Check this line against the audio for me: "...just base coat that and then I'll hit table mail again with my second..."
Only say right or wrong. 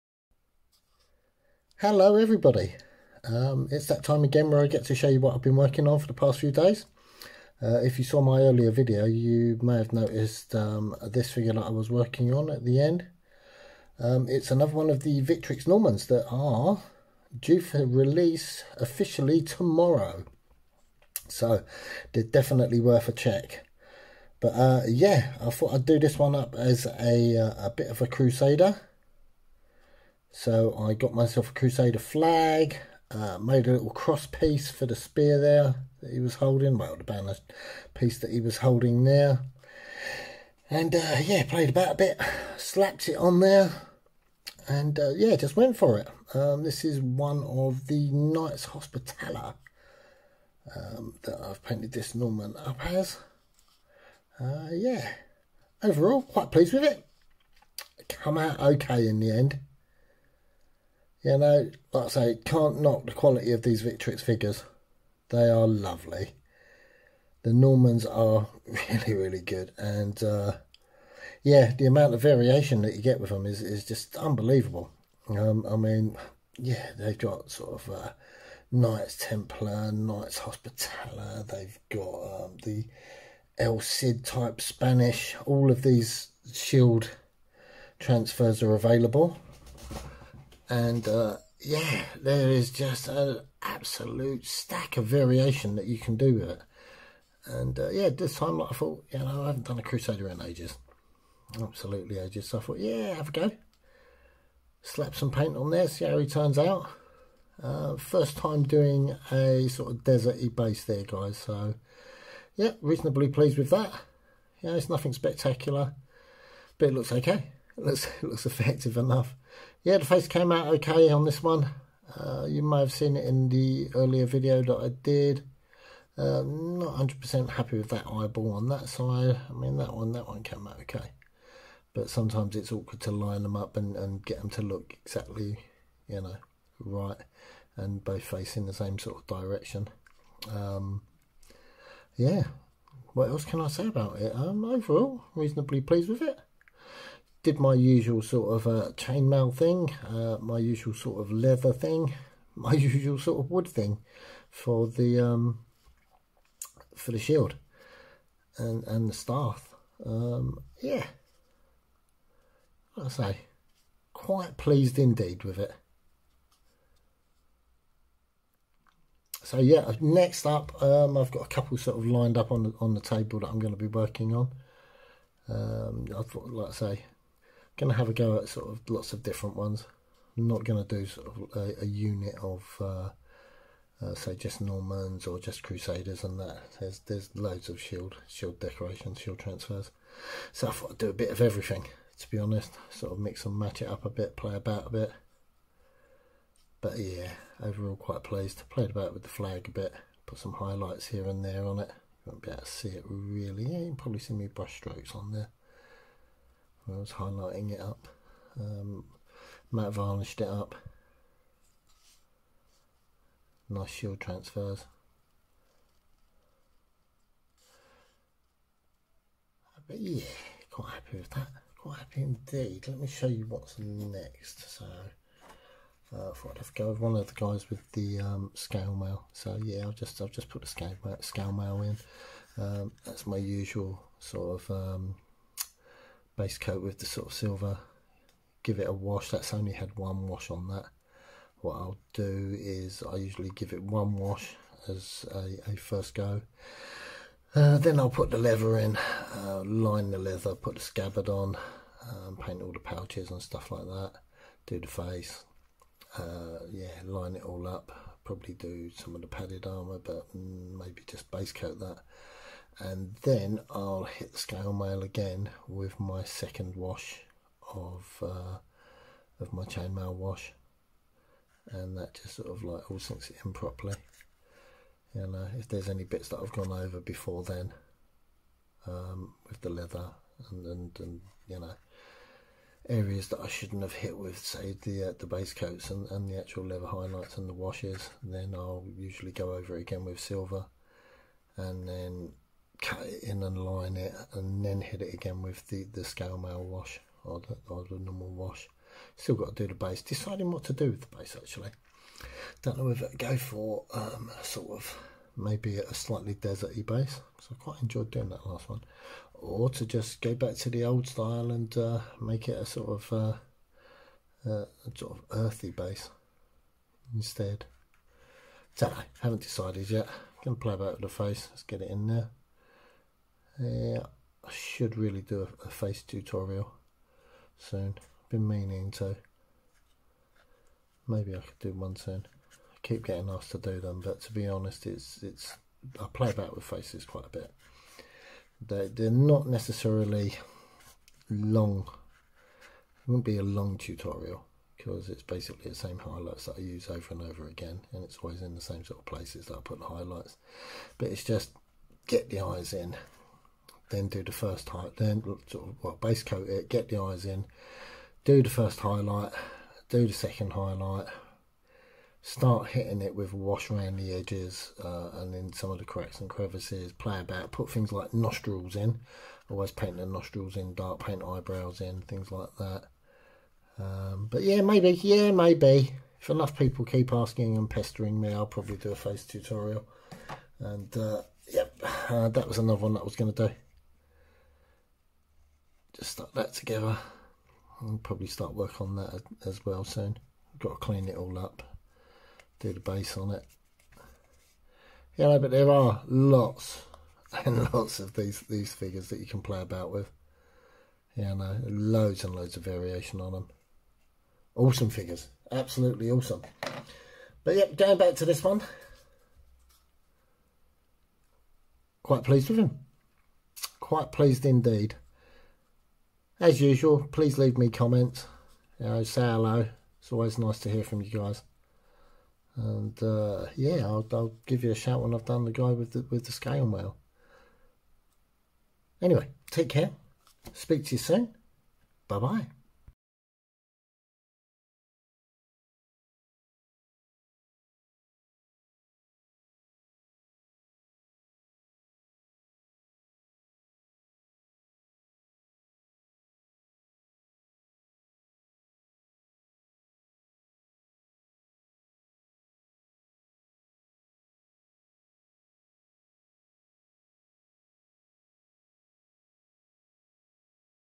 wrong.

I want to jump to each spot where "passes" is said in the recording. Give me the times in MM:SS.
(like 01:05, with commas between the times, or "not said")
not said.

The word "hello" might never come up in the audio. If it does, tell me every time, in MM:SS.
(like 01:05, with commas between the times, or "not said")
00:01, 06:59.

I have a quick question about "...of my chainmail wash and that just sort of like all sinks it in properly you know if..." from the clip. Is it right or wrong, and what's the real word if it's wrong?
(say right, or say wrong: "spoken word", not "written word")
right.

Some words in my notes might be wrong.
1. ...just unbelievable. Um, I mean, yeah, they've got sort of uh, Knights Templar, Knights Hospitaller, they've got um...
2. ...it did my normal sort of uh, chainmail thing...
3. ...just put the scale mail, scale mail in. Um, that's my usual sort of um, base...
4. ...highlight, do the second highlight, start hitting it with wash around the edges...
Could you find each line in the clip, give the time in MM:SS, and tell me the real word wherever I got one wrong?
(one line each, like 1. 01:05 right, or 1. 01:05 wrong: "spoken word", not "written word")
1. 01:13 right
2. 02:26 wrong: "usual", not "normal"
3. 03:50 right
4. 05:58 right.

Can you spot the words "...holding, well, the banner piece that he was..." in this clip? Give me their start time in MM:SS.
00:36.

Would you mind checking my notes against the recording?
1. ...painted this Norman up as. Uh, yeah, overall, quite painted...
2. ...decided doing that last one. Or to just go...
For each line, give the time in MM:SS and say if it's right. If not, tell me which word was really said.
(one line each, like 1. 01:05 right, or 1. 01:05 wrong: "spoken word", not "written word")
1. 00:51 wrong: "pleased", not "painted"
2. 05:07 wrong: "enjoyed", not "decided".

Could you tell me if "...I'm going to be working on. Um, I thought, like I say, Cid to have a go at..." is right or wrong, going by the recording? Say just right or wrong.
wrong.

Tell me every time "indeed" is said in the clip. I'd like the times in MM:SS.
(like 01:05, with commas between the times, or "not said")
02:44, 03:42, 06:54.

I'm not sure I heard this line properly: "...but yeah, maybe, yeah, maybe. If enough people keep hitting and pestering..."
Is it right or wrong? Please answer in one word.
wrong.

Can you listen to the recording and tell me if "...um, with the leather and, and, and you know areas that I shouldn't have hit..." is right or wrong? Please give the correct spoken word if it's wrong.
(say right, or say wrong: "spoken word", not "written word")
right.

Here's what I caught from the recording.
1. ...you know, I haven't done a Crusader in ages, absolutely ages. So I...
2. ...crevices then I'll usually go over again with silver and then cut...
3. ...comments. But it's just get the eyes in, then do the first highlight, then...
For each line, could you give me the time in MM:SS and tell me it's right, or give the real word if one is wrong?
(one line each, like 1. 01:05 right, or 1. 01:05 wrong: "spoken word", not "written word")
1. 01:39 right
2. 04:47 wrong: "washes", not "crevices"
3. 05:49 wrong: "highlights", not "comments".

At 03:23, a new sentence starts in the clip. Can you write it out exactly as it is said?
Yeah, you can probably see me brush strokes on there.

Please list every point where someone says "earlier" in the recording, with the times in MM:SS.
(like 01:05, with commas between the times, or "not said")
00:08, 02:03.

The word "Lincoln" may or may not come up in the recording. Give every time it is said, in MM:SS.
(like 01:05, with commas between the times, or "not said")
not said.